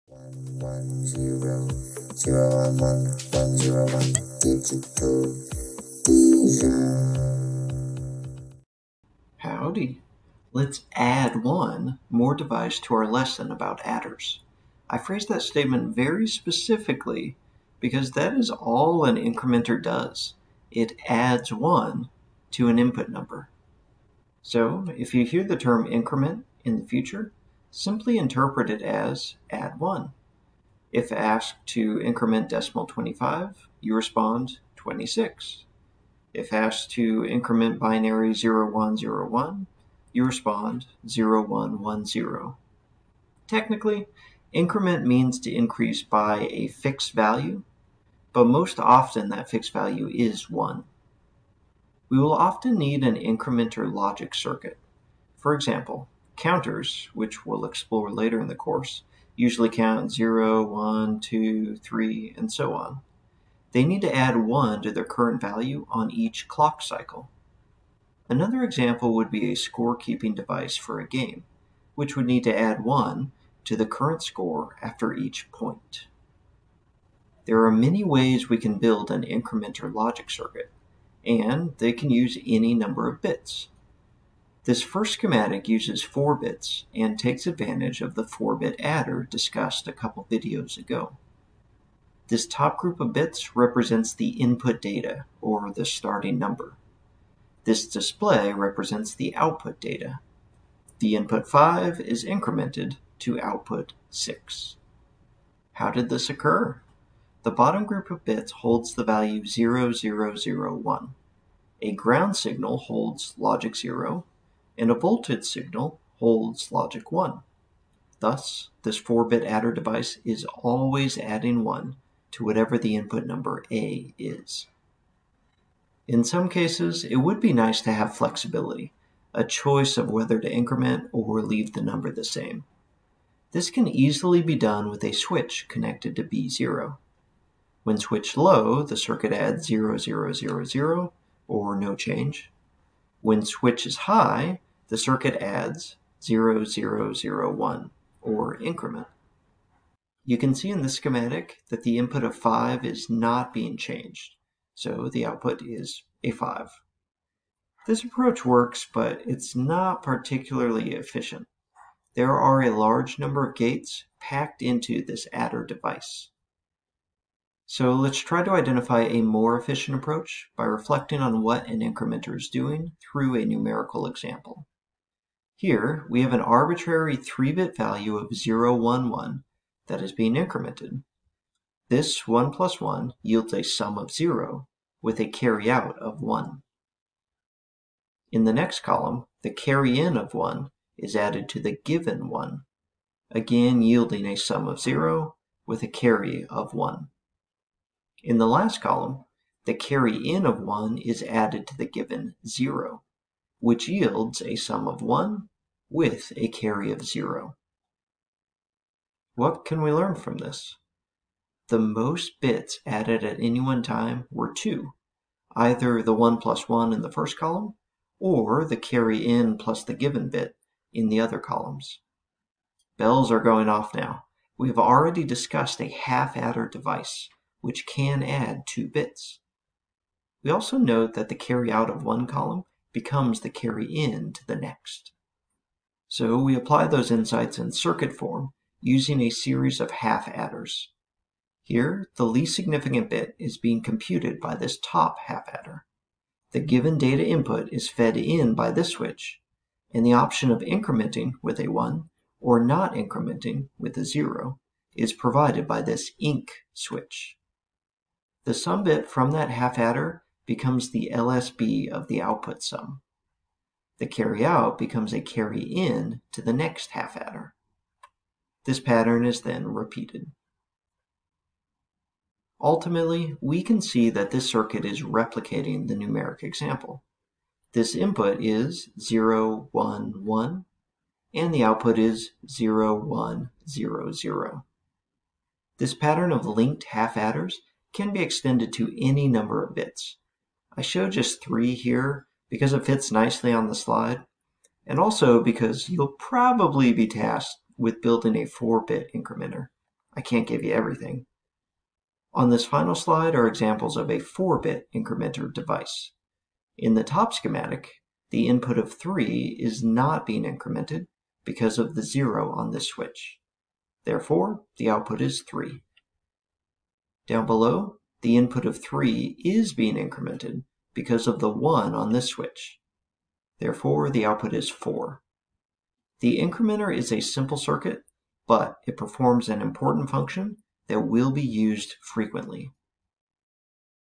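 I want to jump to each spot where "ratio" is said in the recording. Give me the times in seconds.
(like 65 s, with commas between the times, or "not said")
not said.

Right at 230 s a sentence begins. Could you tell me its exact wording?
We also note that the carry out of one column becomes the carry in to the next.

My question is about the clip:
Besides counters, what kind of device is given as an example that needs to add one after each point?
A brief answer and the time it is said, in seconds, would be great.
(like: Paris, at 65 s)
scorekeeping device, at 69 s.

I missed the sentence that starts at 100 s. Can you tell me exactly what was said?
The input 5 is incremented to output 6.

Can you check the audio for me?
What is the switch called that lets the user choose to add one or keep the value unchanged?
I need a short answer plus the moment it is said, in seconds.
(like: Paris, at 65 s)
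INC, at 256 s.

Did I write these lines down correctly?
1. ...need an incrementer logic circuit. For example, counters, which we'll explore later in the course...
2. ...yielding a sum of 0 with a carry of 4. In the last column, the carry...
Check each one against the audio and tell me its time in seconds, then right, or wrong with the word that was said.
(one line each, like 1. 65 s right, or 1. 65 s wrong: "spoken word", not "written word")
1. 52 s right
2. 193 s wrong: "1", not "4".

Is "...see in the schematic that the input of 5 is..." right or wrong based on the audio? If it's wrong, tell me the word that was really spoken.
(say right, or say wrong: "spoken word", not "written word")
right.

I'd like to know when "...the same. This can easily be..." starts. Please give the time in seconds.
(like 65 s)
132 s.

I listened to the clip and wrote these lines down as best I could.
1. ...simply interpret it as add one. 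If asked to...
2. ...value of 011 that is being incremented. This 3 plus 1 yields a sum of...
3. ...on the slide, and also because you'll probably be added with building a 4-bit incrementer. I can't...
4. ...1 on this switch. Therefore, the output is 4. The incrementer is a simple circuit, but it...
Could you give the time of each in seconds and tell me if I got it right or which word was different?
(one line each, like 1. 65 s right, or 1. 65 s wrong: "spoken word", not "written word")
1. 27 s right
2. 177 s wrong: "1", not "3"
3. 293 s wrong: "tasked", not "added"
4. 321 s right.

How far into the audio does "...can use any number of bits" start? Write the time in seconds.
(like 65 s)
81 s.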